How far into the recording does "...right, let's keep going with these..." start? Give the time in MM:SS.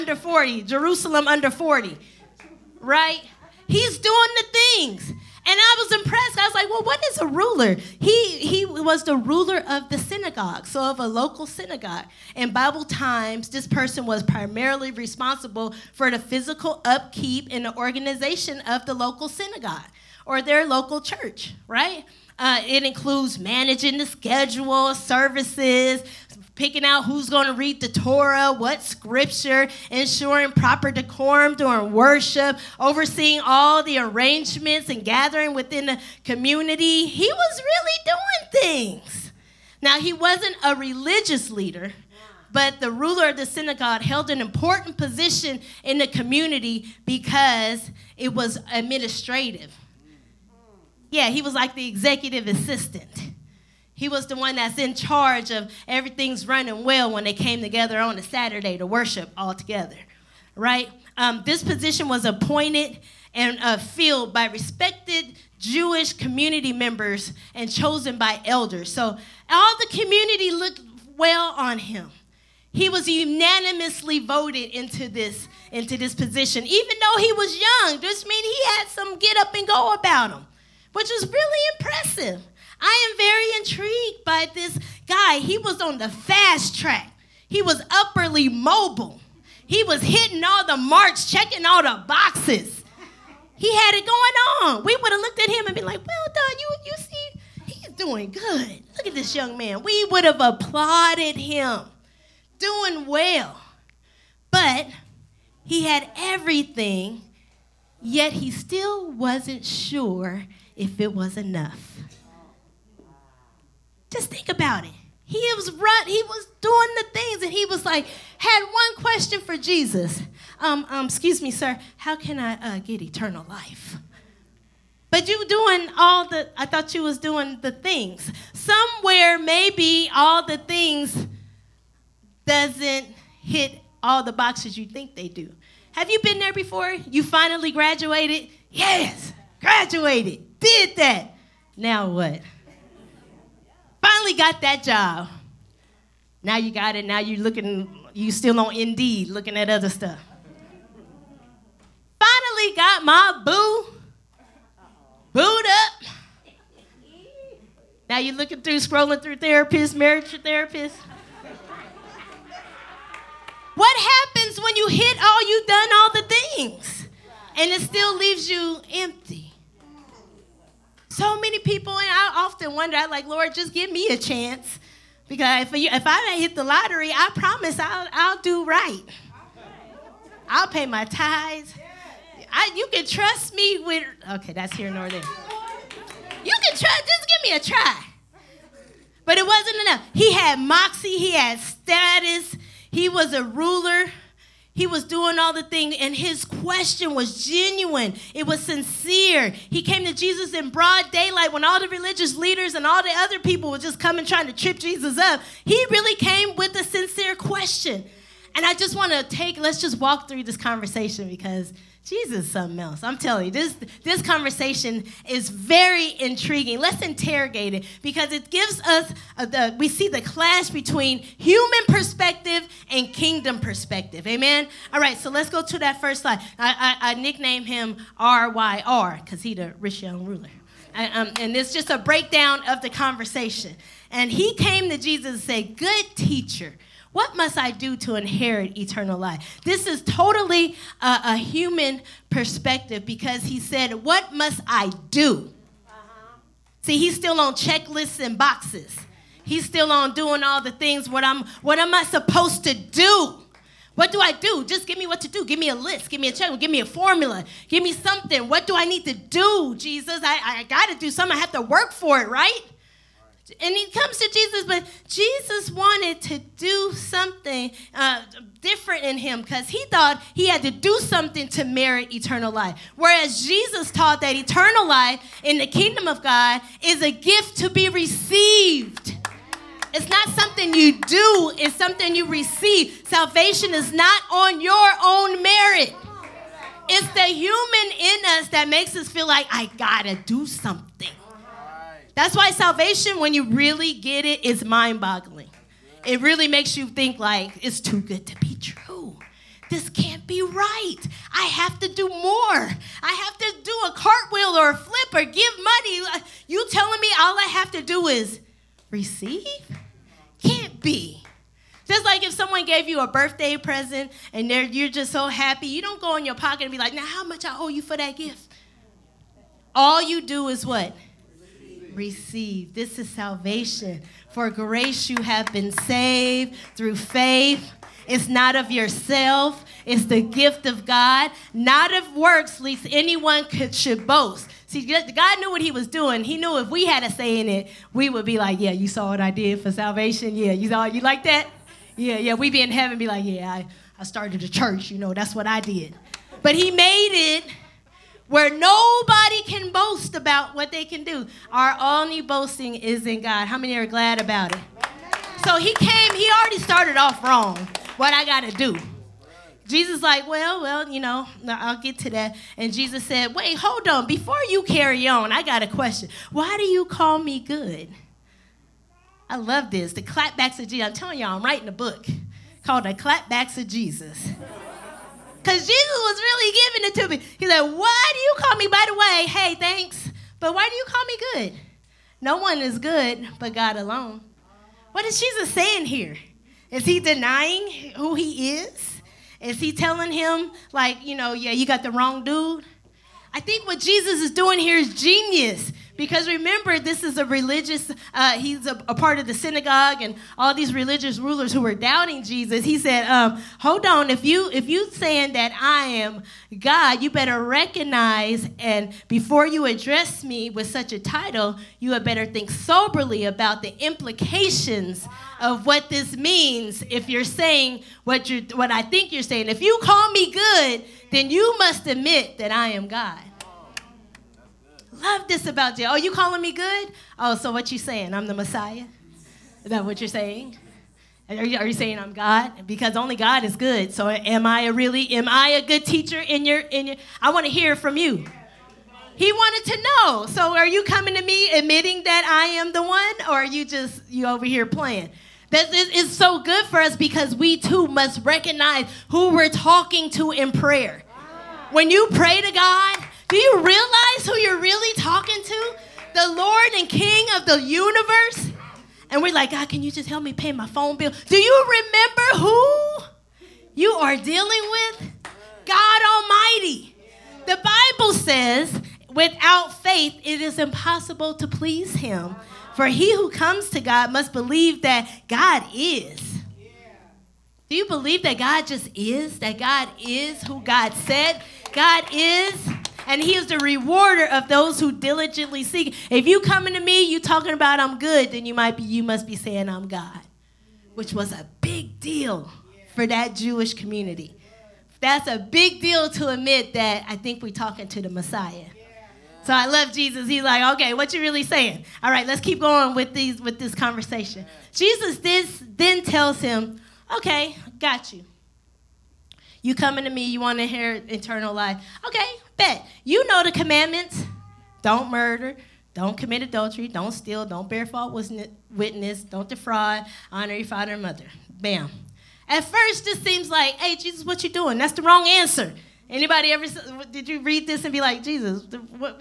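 08:22.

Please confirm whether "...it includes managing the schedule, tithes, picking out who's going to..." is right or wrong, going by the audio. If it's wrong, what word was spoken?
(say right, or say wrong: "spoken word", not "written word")
wrong: "services", not "tithes".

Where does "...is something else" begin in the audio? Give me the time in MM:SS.
03:32.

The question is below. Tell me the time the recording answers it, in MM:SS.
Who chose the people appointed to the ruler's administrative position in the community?
01:08.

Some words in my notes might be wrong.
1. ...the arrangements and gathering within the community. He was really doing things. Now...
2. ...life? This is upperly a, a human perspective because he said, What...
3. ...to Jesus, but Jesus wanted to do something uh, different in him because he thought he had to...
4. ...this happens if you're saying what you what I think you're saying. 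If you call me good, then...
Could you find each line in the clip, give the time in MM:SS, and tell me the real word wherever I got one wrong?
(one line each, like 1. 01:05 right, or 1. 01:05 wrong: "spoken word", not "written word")
1. 00:33 right
2. 03:59 wrong: "totally", not "upperly"
3. 04:24 right
4. 06:55 wrong: "means", not "happens".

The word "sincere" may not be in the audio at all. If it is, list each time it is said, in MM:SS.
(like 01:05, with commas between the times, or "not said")
03:18, 03:26.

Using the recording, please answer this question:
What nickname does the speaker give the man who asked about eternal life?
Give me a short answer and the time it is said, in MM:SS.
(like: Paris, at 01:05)
RYR, at 03:48.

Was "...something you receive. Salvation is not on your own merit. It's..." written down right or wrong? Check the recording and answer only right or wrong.
right.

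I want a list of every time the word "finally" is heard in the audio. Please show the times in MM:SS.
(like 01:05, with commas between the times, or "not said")
02:17, 02:24, 02:32.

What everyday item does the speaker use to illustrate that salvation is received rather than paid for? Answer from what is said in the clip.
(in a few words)
birthday present.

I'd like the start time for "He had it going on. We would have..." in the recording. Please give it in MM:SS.
01:33.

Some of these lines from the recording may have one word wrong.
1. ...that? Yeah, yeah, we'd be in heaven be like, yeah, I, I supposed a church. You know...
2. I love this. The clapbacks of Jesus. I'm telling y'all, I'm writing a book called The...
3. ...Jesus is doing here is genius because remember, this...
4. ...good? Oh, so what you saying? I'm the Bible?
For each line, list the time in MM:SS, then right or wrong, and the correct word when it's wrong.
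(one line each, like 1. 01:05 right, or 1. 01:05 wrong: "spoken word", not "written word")
1. 05:41 wrong: "started", not "supposed"
2. 06:09 right
3. 06:33 right
4. 07:06 wrong: "Messiah", not "Bible".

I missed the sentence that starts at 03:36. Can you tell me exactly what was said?
Let's interrogate it because it gives us, a, the, we see the clash between human perspective and kingdom perspective.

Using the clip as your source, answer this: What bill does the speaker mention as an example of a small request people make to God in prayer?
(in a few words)
phone bill.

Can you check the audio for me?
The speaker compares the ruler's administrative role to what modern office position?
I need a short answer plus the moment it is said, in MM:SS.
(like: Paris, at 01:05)
executive assistant, at 00:51.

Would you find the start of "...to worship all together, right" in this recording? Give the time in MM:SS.
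00:58.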